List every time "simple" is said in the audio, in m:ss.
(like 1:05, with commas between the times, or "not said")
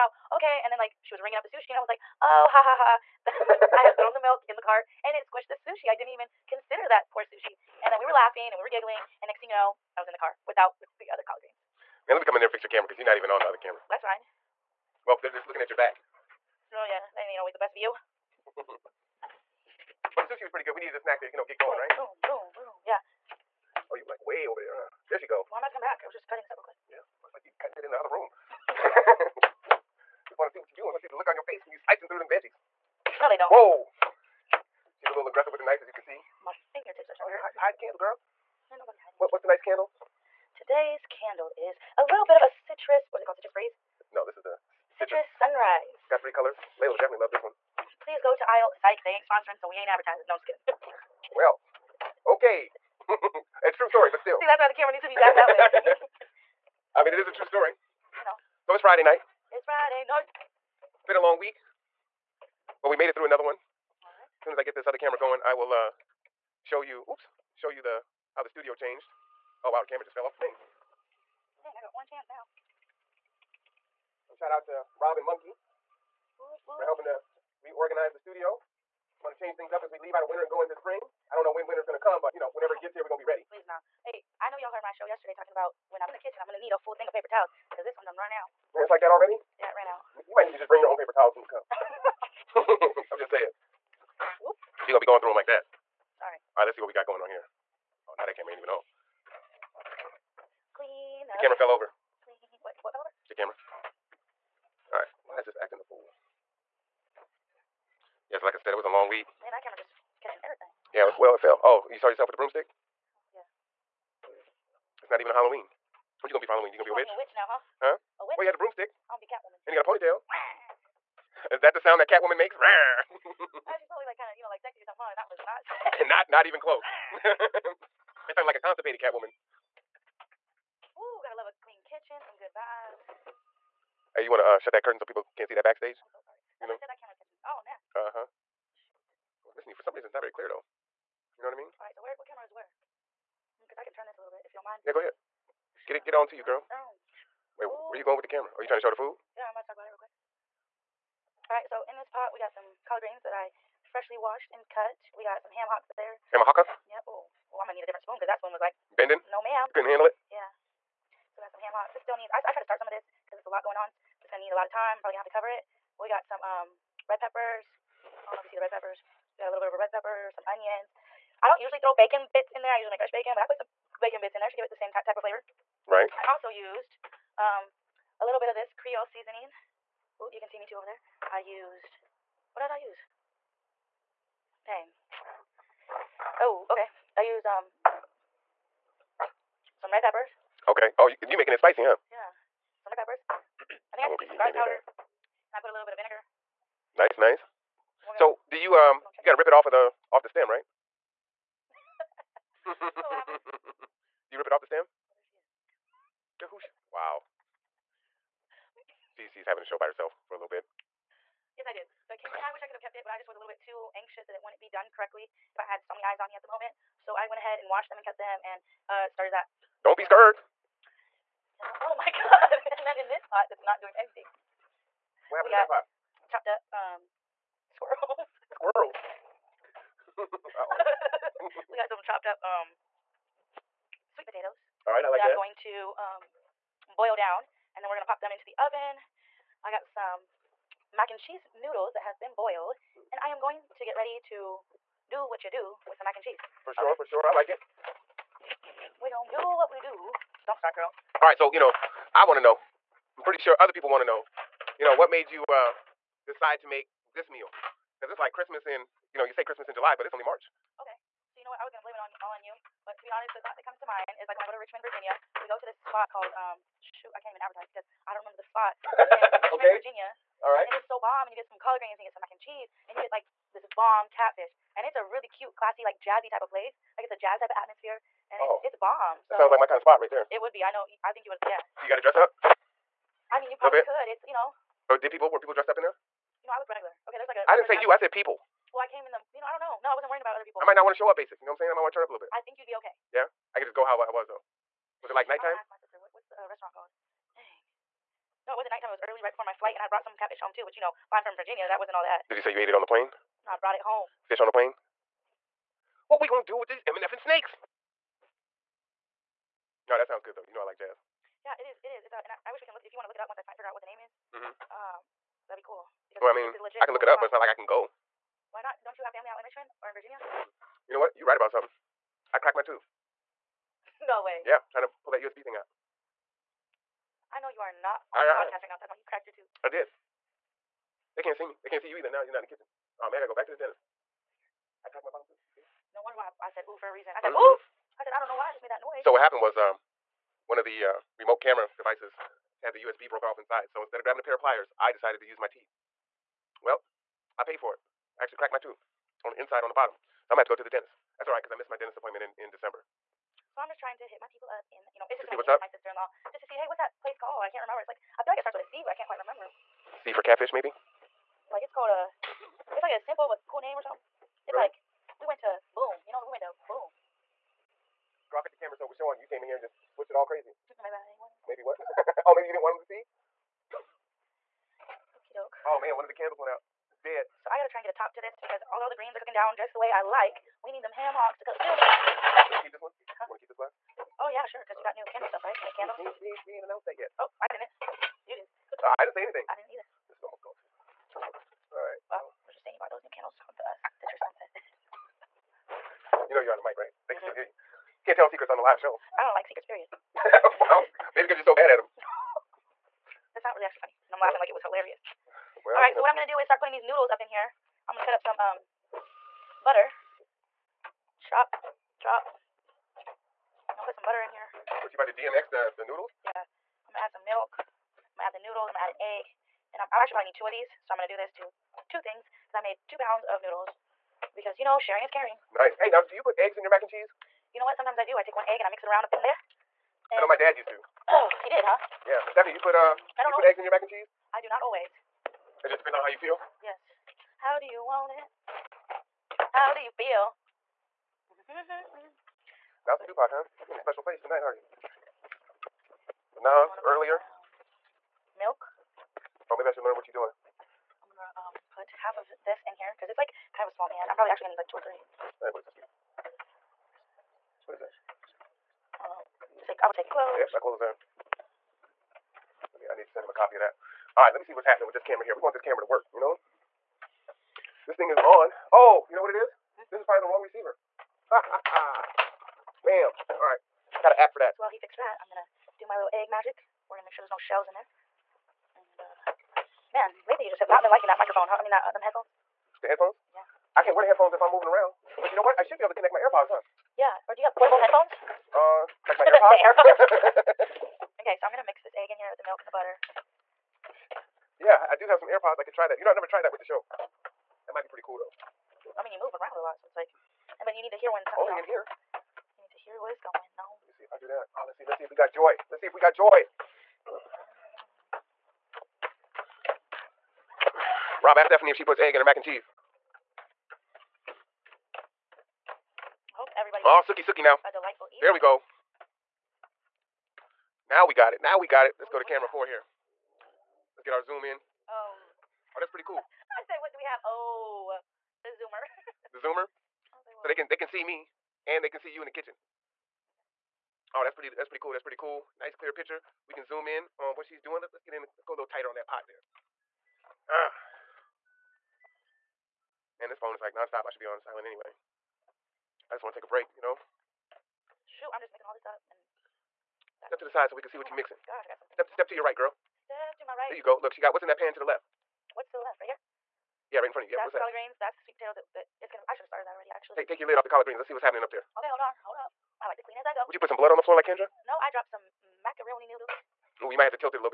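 6:02.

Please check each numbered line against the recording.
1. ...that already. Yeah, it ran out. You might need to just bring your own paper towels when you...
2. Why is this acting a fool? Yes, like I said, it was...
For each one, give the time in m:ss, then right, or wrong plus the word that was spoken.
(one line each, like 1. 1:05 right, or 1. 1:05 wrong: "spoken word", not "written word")
1. 1:29 right
2. 1:45 right.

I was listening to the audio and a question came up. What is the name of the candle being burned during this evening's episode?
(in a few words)
Citrus Sunrise.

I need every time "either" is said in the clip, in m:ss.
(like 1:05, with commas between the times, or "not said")
5:31, 6:29.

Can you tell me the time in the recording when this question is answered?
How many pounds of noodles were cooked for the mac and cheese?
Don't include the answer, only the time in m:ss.
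7:02.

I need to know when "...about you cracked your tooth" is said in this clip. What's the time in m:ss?
5:28.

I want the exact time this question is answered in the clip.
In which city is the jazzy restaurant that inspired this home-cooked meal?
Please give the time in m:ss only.
4:24.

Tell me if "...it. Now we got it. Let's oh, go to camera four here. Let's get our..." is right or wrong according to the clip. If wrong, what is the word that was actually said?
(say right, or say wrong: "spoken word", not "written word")
right.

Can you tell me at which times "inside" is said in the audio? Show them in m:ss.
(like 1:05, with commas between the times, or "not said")
5:43, 5:49.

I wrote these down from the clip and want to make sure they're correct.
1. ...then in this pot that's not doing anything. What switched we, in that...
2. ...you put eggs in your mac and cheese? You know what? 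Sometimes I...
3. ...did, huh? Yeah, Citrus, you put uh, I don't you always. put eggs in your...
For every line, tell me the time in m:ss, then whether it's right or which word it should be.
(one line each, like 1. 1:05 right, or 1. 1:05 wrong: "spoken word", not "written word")
1. 3:42 wrong: "happened", not "switched"
2. 7:06 right
3. 7:11 wrong: "Stephanie", not "Citrus".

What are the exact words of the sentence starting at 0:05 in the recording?
I didn't even consider that poor sushi.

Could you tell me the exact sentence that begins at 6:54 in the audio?
What you about to DMX the the noodles?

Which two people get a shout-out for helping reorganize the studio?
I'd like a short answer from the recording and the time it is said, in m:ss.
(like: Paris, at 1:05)
Rob and Monkey, at 1:14.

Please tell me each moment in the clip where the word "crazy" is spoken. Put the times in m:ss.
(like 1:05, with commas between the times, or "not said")
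6:10.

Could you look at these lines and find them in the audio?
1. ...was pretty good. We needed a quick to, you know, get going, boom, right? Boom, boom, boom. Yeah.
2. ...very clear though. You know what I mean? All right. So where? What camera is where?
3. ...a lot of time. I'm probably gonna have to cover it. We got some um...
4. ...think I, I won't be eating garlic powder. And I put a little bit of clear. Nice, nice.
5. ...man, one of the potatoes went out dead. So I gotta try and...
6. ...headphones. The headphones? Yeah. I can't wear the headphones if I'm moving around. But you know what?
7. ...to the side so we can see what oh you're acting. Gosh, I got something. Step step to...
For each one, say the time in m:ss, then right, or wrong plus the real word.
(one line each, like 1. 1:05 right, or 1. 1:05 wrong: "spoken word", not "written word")
1. 0:20 wrong: "snack", not "quick"
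2. 2:20 right
3. 2:44 right
4. 3:13 wrong: "vinegar", not "clear"
5. 6:15 wrong: "candles", not "potatoes"
6. 8:02 right
7. 9:10 wrong: "mixing", not "acting".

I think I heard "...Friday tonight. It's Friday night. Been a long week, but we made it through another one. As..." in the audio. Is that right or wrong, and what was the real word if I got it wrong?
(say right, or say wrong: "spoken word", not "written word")
wrong: "night", not "tonight".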